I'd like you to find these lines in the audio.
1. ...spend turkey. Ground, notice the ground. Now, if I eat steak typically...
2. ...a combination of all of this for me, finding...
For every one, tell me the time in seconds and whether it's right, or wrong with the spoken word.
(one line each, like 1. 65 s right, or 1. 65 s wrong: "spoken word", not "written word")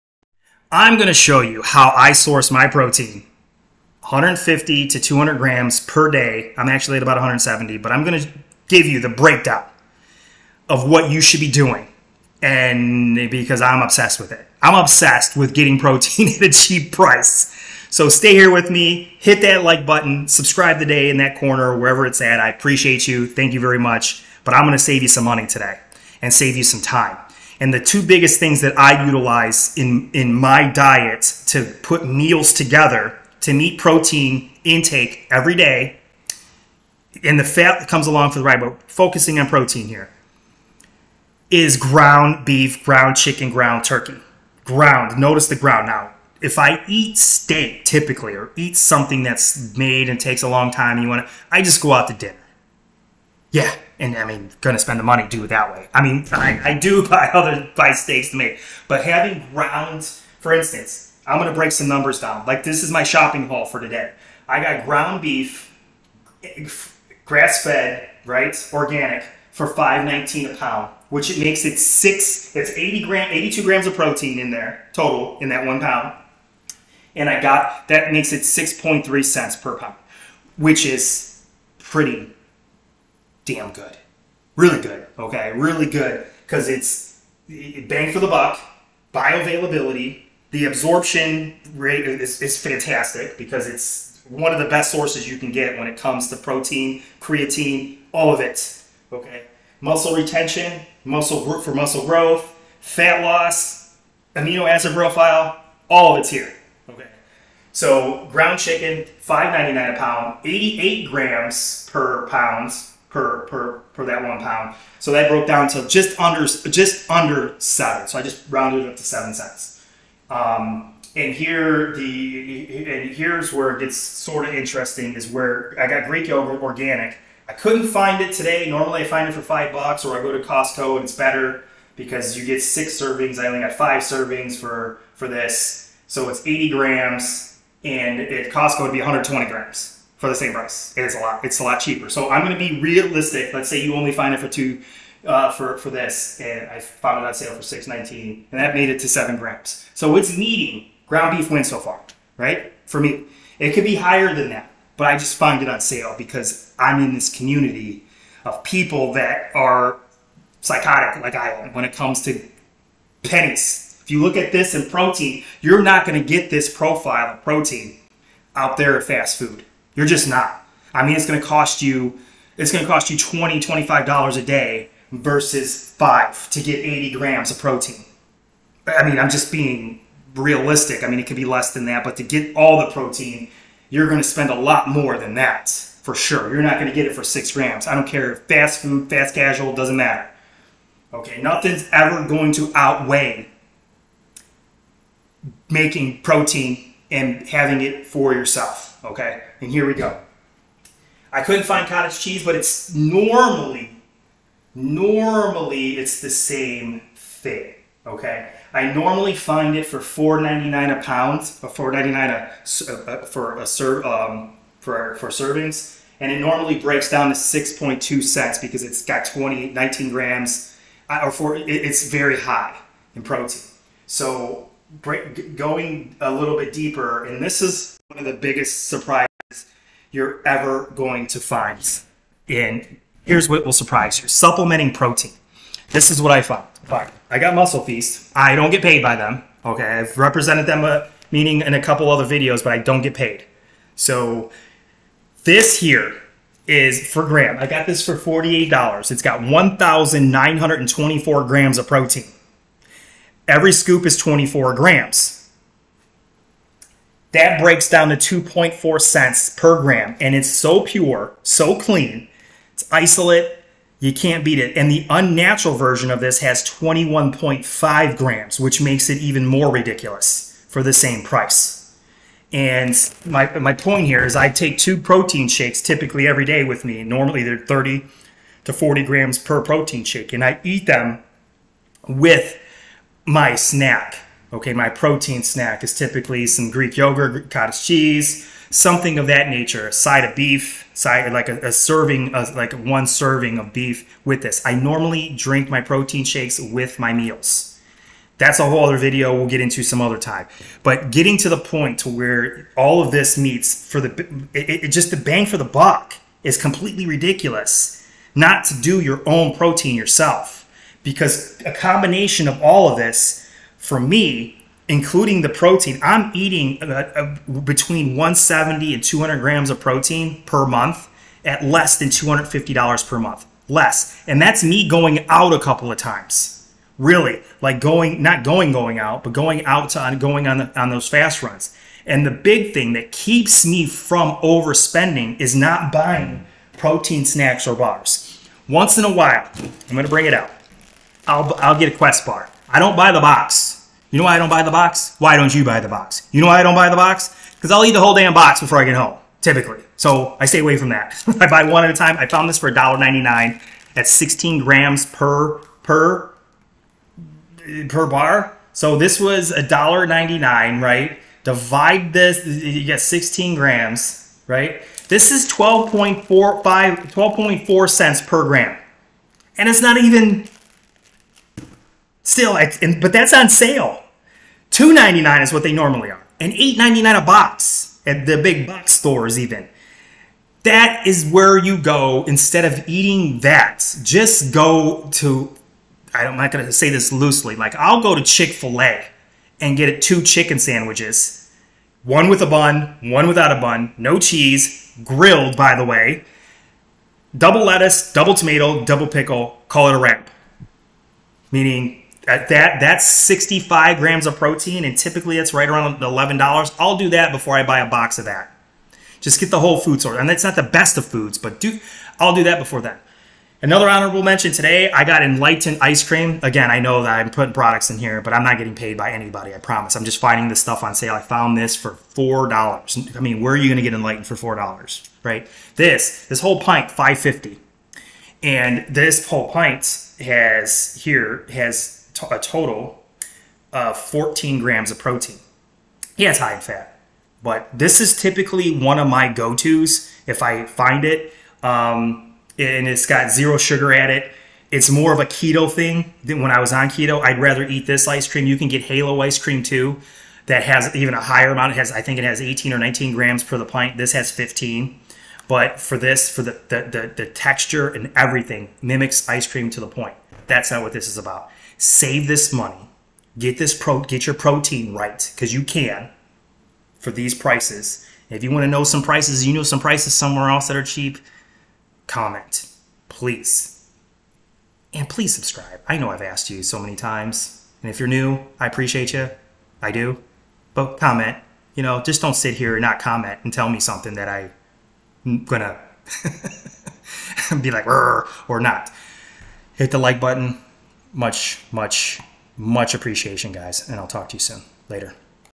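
1. 43 s wrong: "ground", not "spend"
2. 311 s wrong: "including", not "finding".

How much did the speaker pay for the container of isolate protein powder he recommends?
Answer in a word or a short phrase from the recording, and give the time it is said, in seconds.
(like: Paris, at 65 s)
$48, at 248 s.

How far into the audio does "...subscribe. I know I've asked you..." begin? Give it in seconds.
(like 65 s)
475 s.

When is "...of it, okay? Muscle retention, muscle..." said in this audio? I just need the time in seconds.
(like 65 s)
98 s.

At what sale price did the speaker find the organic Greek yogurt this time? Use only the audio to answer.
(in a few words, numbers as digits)
$6.19.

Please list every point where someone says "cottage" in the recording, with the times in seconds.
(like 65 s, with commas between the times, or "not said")
201 s, 287 s.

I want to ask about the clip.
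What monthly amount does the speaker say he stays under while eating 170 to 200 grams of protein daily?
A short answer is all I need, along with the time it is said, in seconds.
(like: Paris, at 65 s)
$250, at 322 s.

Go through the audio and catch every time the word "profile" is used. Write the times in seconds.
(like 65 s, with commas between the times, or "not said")
104 s, 166 s.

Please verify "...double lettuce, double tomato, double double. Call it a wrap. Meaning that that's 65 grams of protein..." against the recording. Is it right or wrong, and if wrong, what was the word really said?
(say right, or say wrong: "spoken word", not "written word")
wrong: "pickle", not "double".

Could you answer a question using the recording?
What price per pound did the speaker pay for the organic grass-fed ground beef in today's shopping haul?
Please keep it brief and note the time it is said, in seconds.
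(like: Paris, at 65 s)
$5.19, at 69 s.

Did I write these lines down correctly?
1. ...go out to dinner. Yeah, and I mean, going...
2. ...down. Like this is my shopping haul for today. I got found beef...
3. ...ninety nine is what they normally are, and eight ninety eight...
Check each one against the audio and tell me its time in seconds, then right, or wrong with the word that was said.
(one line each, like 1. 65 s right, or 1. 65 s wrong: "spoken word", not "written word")
1. 51 s right
2. 62 s wrong: "ground", not "found"
3. 374 s wrong: "nine", not "eight".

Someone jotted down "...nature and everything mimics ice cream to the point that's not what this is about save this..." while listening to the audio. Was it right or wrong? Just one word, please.
wrong.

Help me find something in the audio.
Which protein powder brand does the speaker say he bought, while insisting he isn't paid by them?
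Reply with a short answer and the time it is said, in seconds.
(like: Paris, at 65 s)
Muscle Feast, at 237 s.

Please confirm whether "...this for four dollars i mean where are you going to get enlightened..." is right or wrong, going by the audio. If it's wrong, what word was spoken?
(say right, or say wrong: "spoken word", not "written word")
right.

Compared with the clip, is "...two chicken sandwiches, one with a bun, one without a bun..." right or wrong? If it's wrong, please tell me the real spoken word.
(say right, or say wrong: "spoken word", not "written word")
right.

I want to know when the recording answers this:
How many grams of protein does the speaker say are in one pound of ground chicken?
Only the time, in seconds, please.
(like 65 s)
110 s.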